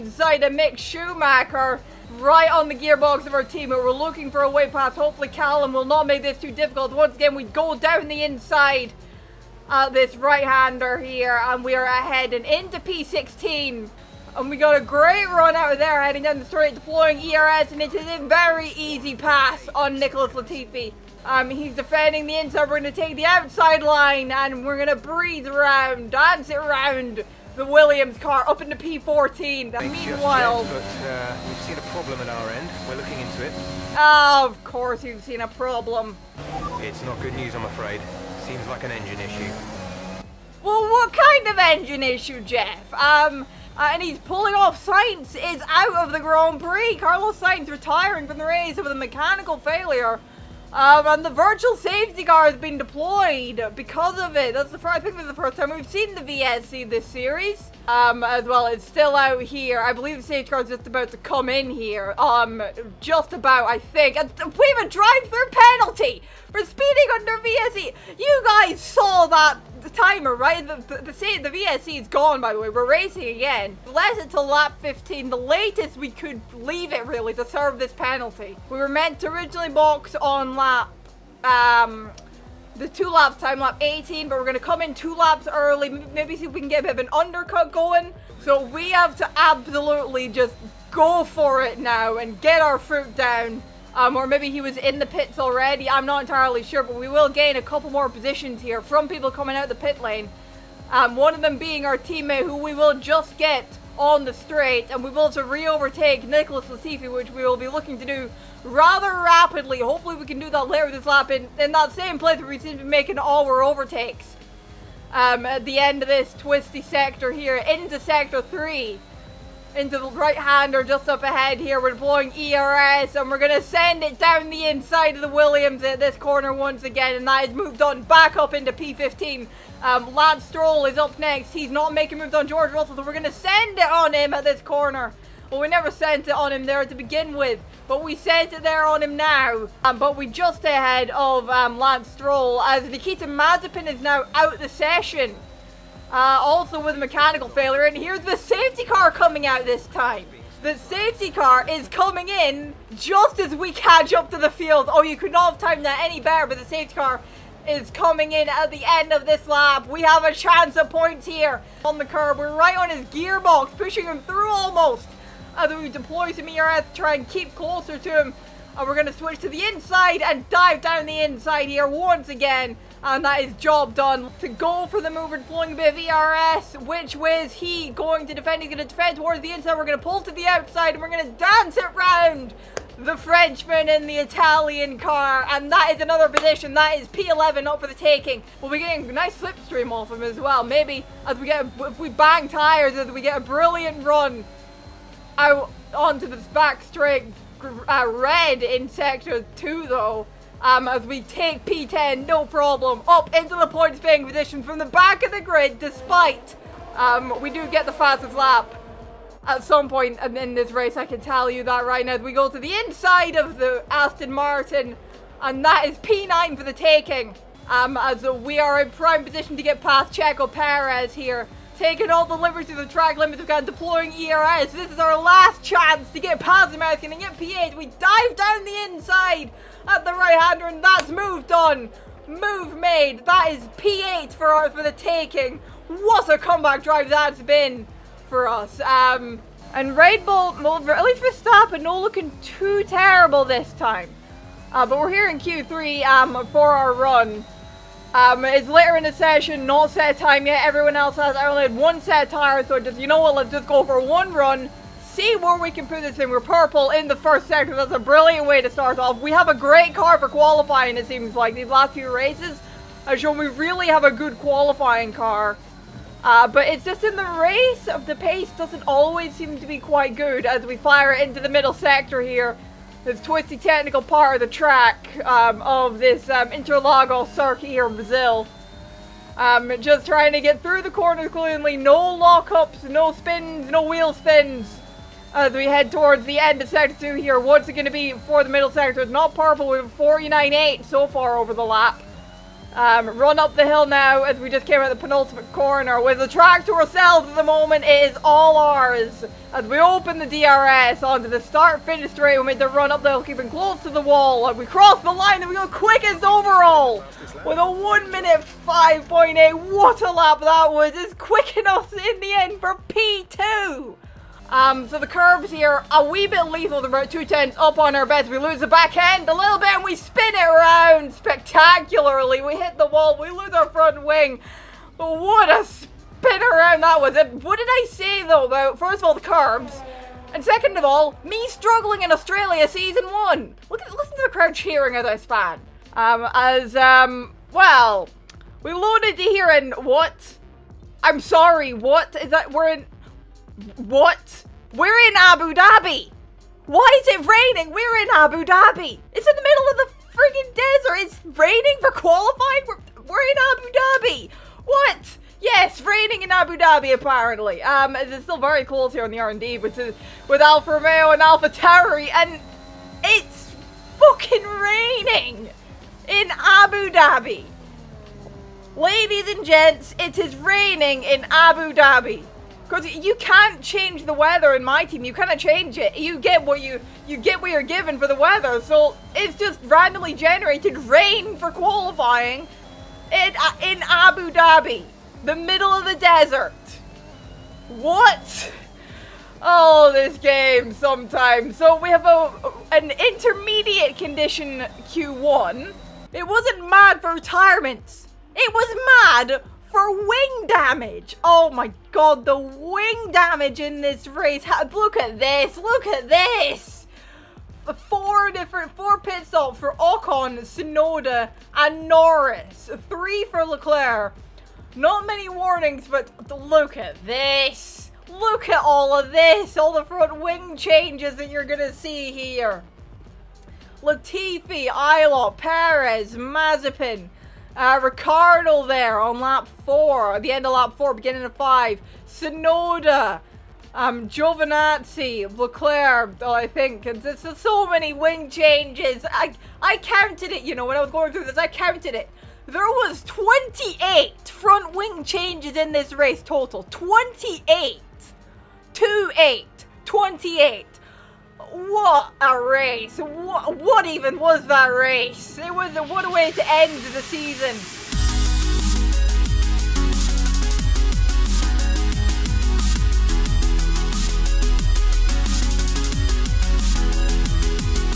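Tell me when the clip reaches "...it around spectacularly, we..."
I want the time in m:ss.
5:20.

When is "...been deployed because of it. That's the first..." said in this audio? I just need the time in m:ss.
0:52.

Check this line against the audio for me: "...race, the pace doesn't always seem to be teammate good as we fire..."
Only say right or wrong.
wrong.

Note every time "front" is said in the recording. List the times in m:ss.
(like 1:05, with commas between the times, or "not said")
5:23, 6:59, 7:24.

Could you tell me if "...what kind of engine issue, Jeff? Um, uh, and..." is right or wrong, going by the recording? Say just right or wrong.
right.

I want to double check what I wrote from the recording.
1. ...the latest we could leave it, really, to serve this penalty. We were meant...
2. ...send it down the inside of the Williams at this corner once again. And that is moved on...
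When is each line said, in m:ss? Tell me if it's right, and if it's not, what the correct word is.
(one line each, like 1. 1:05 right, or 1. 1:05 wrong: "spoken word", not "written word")
1. 1:15 right
2. 2:03 right.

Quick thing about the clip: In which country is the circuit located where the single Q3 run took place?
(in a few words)
Brazil.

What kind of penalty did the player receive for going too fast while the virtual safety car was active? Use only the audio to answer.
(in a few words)
Drive-through penalty.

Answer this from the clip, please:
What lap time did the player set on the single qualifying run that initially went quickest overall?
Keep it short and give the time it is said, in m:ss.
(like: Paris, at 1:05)
1:05.8, at 5:07.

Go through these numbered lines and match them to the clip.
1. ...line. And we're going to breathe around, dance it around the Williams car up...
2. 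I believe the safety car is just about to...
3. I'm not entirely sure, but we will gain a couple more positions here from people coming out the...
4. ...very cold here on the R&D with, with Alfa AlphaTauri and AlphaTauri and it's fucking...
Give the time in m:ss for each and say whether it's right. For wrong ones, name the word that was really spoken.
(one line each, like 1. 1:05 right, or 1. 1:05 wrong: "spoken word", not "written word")
1. 0:23 right
2. 0:59 right
3. 1:35 right
4. 5:58 wrong: "Romeo", not "AlphaTauri".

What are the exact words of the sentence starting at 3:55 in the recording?
What a comeback drive that's been for us.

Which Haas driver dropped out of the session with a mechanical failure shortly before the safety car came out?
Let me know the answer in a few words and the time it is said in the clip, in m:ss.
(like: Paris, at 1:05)
Nikita Mazepin, at 2:22.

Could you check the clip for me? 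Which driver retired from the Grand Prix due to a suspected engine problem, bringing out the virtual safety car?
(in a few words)
Carlos Sainz.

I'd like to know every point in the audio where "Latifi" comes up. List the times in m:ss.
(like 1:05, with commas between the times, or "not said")
0:20, 1:46, 7:03.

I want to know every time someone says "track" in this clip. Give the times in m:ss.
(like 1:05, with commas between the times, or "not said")
3:42, 4:34, 4:56.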